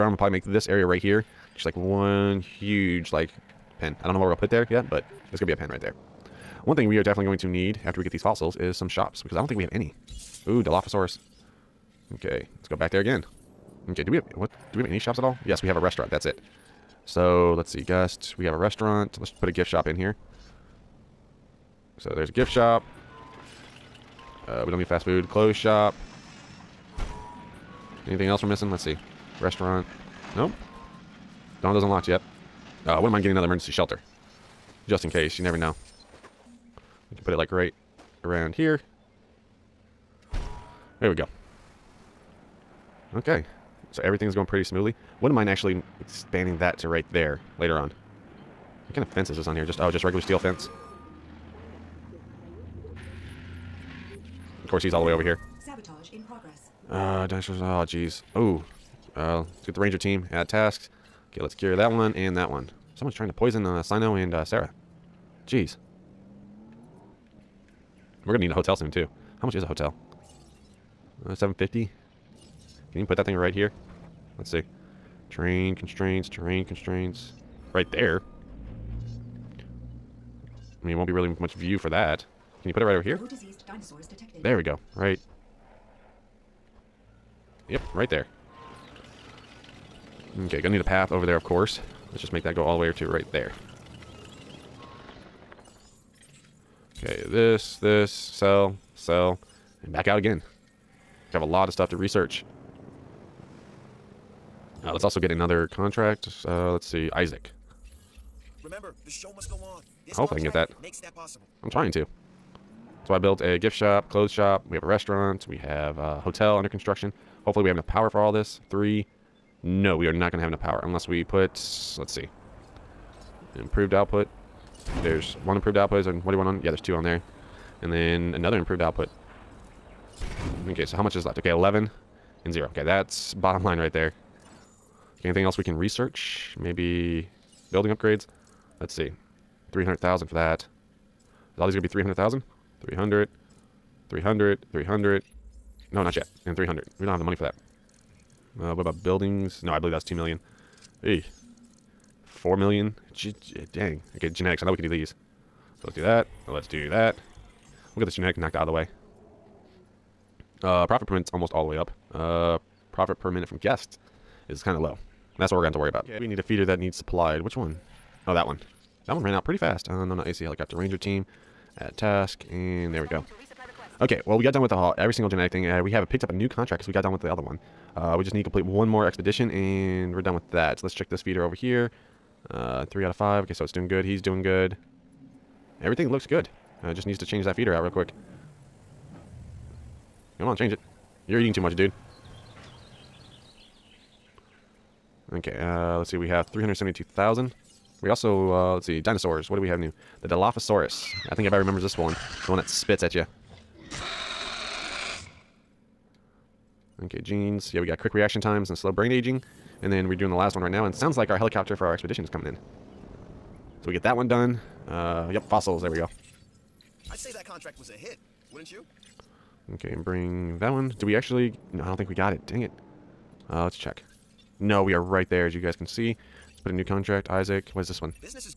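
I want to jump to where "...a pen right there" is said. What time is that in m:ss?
0:05.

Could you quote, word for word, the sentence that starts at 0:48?
What kind of fence is this on here?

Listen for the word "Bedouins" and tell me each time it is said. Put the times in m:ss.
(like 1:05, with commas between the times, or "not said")
not said.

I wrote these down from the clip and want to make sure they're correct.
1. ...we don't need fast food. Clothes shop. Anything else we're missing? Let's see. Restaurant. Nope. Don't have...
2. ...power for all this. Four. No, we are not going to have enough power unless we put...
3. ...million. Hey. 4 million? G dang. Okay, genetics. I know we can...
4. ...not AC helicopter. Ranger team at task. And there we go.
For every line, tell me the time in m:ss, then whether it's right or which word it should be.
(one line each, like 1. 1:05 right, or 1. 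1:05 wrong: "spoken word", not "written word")
1. 0:24 right
2. 1:57 wrong: "Three", not "Four"
3. 2:30 right
4. 2:50 right.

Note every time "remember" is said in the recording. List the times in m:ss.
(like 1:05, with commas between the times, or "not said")
1:48, 3:21.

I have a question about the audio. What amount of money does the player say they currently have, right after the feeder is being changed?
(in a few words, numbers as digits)
372,000.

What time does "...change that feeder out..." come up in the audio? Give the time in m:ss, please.
3:07.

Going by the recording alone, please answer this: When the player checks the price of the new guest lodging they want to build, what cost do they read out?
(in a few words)
750.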